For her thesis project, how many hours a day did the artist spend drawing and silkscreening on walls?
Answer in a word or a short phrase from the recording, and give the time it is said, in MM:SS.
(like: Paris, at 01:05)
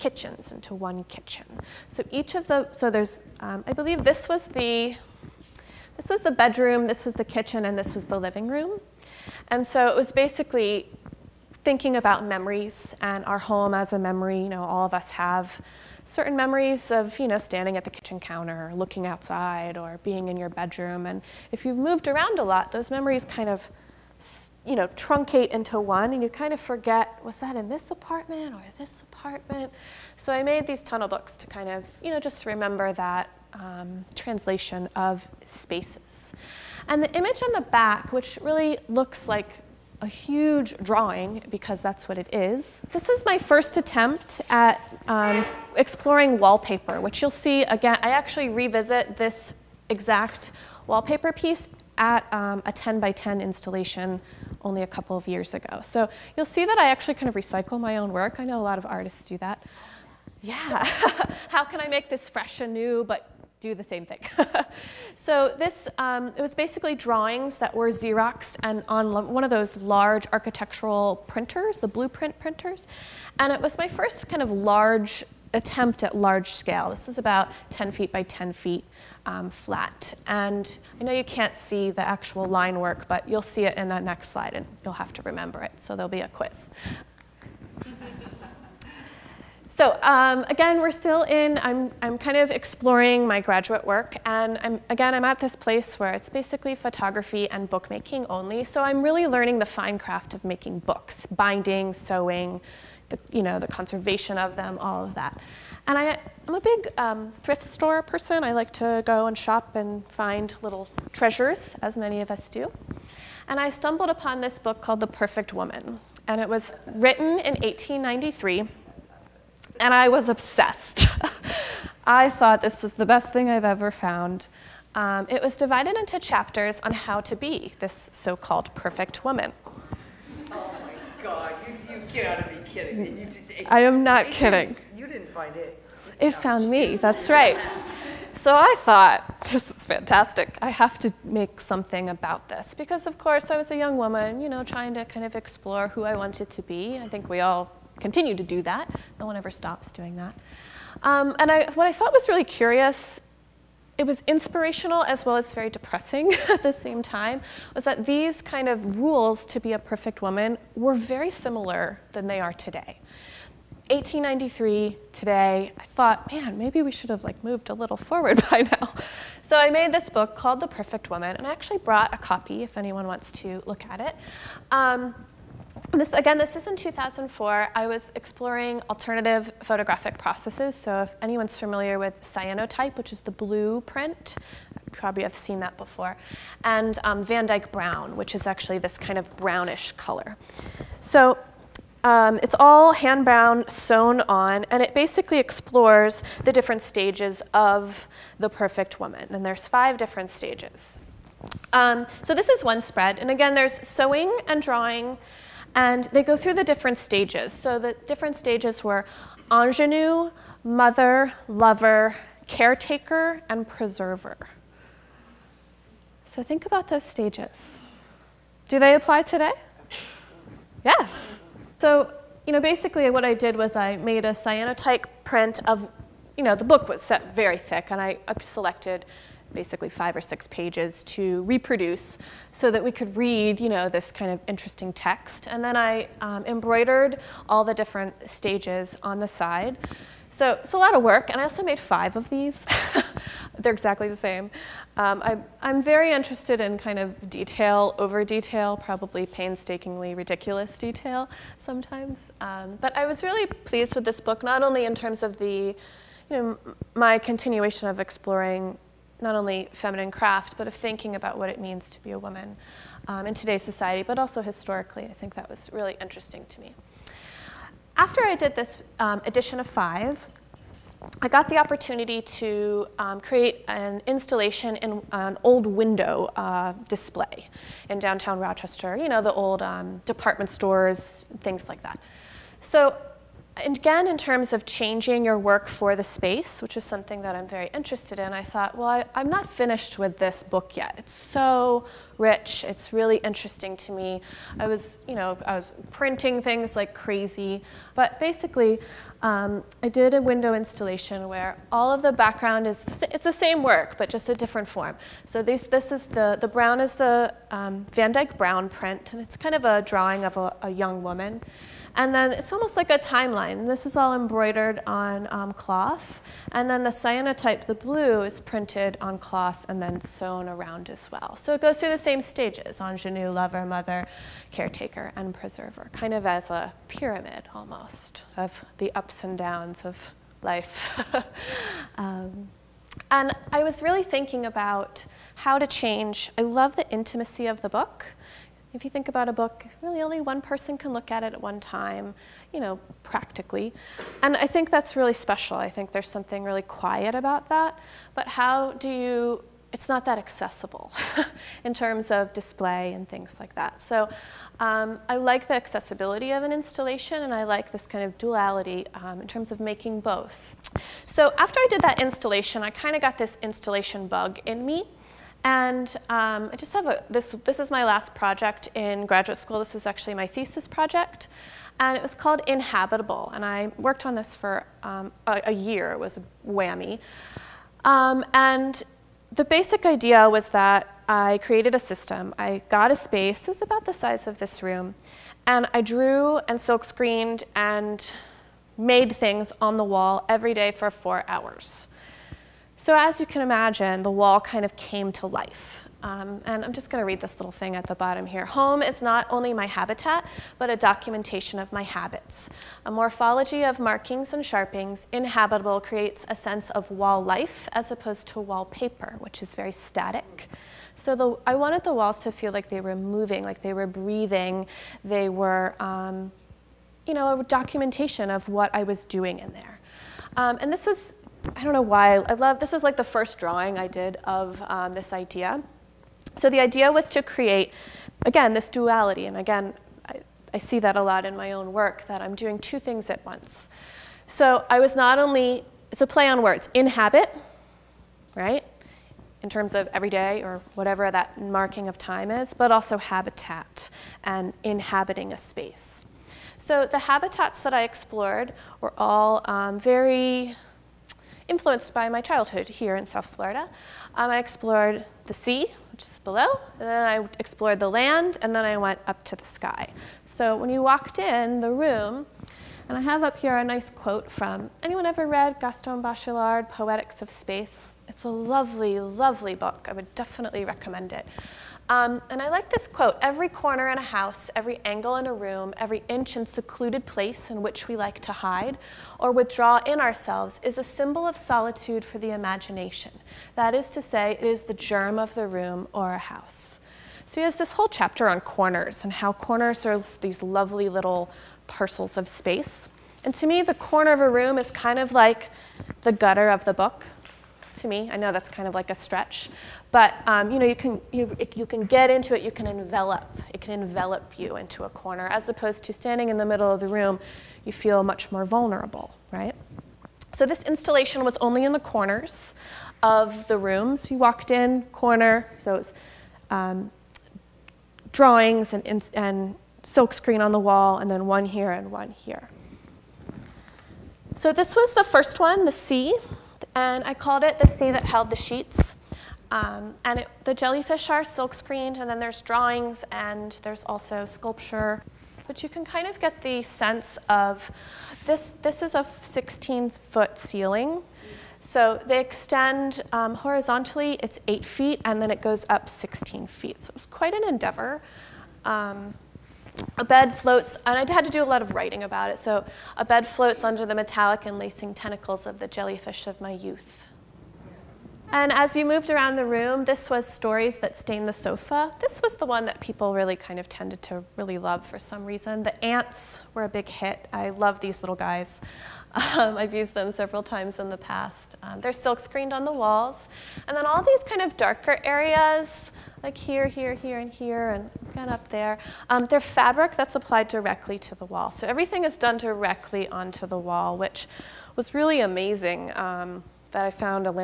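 4, at 06:30.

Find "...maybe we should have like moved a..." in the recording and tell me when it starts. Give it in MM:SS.
02:46.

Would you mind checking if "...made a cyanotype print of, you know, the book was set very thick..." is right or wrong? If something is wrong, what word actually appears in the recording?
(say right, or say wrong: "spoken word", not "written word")
right.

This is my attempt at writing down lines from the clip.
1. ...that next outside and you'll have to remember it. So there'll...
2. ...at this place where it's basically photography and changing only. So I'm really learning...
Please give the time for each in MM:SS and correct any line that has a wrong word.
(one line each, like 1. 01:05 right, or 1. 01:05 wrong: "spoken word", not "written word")
1. 01:23 wrong: "slide", not "outside"
2. 01:35 wrong: "bookmaking", not "changing".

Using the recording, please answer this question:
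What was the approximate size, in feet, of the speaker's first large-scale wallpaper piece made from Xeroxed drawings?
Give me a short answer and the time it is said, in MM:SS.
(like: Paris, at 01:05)
10 feet by 10 feet, at 01:17.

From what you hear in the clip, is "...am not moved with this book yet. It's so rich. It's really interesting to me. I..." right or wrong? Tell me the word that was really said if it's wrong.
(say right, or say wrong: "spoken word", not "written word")
wrong: "finished", not "moved".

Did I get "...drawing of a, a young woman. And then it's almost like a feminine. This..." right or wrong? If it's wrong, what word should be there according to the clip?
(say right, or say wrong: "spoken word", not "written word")
wrong: "timeline", not "feminine".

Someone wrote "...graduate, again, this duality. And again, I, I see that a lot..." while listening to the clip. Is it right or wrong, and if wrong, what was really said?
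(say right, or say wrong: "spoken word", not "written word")
wrong: "create", not "graduate".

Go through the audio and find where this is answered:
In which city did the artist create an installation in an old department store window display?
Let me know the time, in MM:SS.
04:38.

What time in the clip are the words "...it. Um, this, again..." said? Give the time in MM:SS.
02:54.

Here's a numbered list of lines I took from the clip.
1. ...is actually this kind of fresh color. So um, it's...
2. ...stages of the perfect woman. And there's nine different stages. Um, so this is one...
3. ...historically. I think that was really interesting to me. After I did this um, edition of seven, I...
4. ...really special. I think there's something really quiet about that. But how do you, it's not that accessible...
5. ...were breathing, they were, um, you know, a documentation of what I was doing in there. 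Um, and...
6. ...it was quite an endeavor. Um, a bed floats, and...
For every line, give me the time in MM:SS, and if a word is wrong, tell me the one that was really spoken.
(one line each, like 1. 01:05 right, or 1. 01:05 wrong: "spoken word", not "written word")
1. 03:08 wrong: "brownish", not "fresh"
2. 03:16 wrong: "five", not "nine"
3. 04:24 wrong: "five", not "seven"
4. 05:44 right
5. 06:53 right
6. 09:06 right.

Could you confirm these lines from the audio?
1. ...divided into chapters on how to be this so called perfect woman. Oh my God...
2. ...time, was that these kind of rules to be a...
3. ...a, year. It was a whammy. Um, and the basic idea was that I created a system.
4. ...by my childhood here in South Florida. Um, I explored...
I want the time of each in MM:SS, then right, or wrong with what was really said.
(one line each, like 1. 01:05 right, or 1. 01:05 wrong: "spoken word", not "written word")
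1. 02:05 right
2. 02:37 right
3. 06:15 right
4. 07:31 right.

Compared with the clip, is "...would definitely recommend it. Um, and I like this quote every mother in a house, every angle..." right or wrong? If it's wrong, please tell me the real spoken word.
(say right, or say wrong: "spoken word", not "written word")
wrong: "corner", not "mother".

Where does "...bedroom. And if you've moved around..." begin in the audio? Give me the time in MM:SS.
00:20.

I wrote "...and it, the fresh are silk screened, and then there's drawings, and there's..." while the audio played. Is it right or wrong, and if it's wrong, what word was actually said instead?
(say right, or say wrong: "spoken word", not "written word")
wrong: "jellyfish", not "fresh".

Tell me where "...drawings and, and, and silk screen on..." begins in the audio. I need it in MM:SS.
08:38.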